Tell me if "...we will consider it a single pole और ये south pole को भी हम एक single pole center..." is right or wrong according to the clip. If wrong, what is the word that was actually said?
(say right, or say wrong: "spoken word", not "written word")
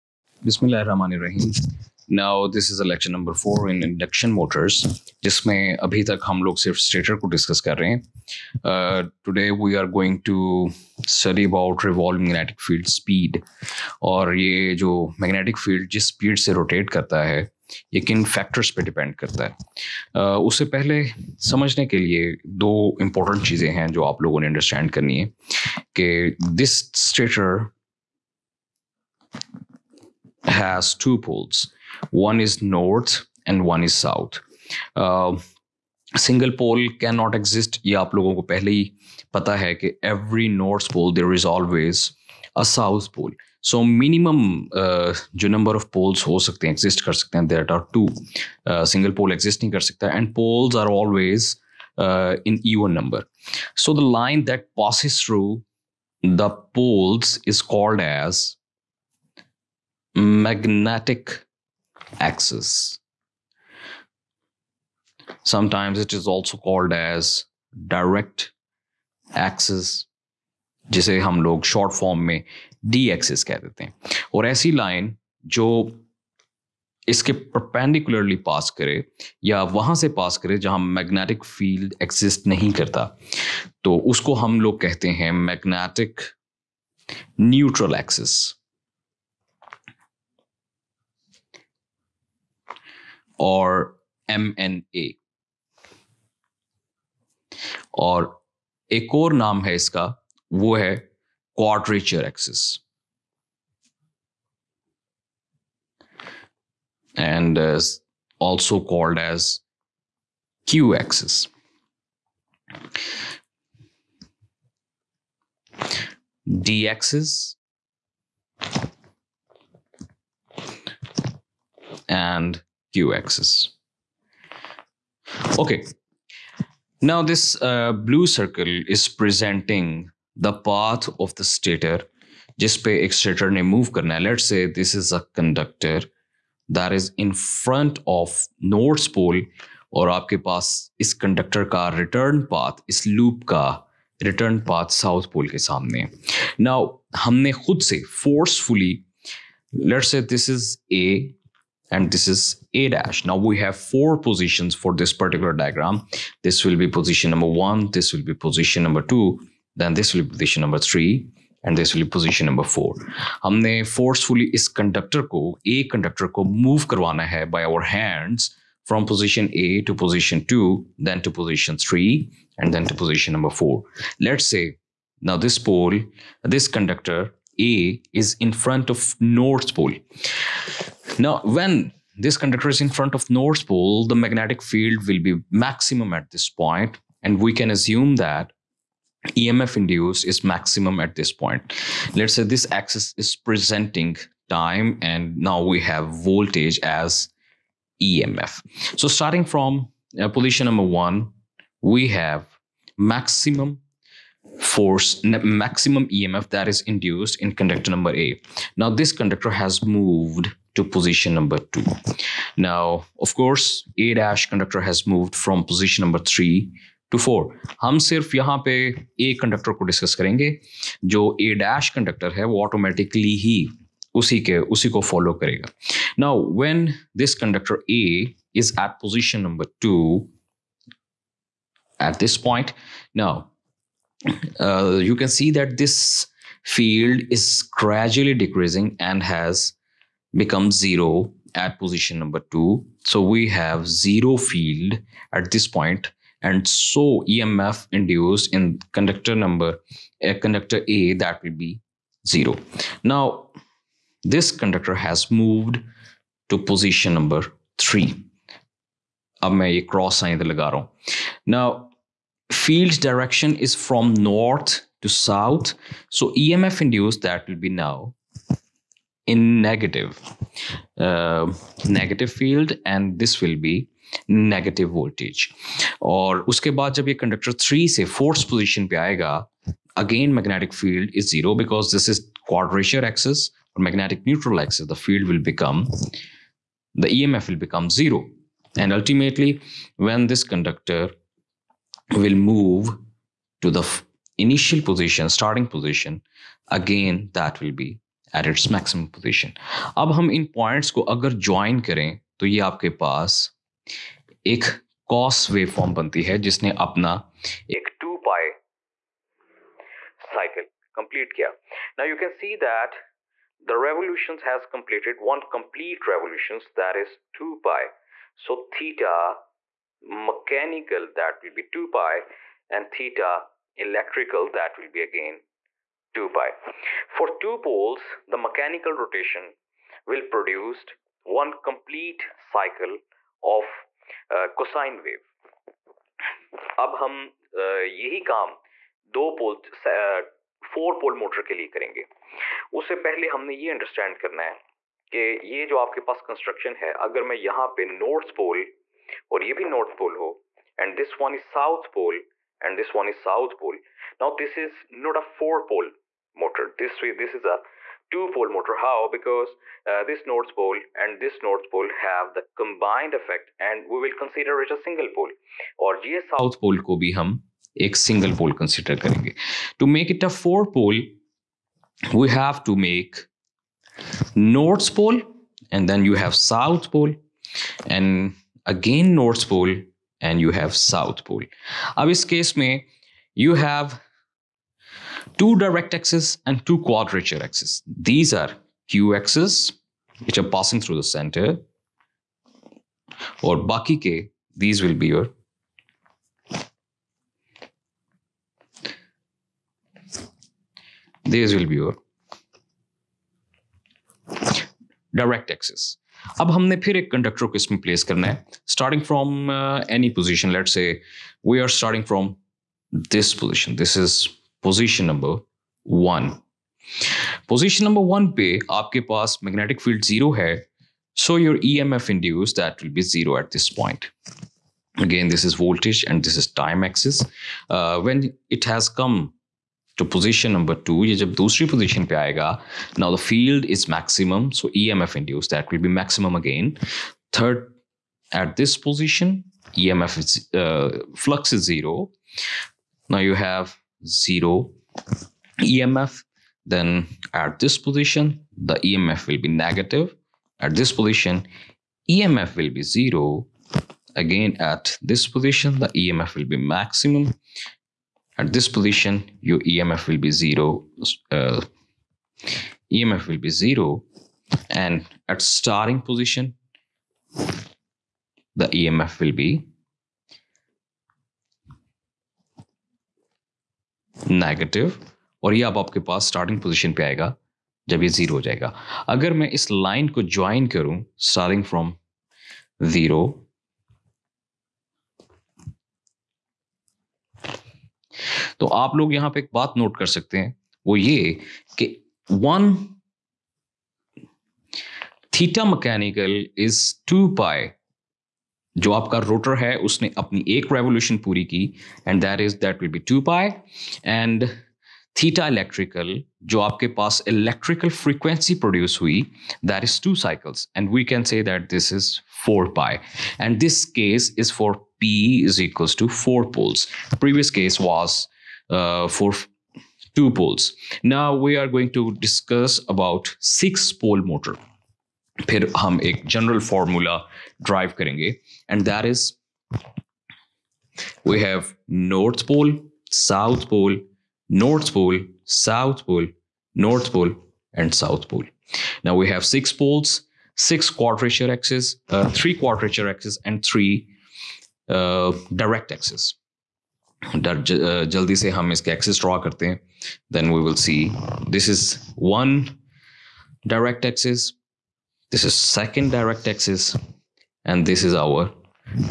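wrong: "consider", not "center".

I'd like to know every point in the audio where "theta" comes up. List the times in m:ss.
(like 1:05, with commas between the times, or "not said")
5:18, 5:22.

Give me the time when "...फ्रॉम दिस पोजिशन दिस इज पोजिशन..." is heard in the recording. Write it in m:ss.
6:52.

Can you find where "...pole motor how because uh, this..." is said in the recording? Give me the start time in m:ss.
5:58.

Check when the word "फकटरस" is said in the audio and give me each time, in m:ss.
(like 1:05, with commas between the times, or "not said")
0:18.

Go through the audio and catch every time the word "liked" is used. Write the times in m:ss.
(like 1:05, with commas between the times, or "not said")
not said.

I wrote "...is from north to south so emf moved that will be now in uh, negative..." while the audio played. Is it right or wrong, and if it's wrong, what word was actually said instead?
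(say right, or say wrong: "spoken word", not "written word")
wrong: "induced", not "moved".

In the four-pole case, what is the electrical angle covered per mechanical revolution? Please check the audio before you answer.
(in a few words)
4 pi.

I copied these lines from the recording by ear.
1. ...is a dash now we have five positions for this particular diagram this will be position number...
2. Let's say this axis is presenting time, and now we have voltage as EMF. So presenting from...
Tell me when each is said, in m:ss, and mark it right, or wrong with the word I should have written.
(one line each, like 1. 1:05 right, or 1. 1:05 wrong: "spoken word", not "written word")
1. 2:32 wrong: "four", not "five"
2. 3:12 wrong: "starting", not "presenting".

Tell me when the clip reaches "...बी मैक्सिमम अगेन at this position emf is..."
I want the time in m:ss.
7:15.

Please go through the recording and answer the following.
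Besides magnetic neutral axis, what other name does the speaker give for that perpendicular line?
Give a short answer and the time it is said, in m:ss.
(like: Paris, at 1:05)
quadrature axis, at 1:41.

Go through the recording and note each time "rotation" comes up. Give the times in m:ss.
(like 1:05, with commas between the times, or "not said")
5:28.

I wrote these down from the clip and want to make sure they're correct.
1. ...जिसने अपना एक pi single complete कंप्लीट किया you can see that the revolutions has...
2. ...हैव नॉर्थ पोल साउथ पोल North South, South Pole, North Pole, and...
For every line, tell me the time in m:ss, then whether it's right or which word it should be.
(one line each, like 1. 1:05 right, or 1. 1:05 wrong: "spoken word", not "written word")
1. 5:06 wrong: "cycle", not "single"
2. 8:51 wrong: "Pole", not "South".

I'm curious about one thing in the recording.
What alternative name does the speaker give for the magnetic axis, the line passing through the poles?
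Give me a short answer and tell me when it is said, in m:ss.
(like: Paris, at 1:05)
direct axis, at 1:07.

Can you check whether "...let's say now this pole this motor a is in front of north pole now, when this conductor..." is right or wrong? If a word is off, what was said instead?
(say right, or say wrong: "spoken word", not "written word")
wrong: "conductor", not "motor".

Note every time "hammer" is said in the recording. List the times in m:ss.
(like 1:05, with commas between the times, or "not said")
not said.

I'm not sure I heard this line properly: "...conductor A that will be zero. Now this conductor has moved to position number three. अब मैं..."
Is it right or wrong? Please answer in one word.
right.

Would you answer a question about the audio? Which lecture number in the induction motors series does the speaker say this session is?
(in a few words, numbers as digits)
4.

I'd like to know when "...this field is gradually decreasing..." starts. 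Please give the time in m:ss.
3:55.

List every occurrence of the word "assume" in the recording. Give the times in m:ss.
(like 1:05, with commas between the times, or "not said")
3:07.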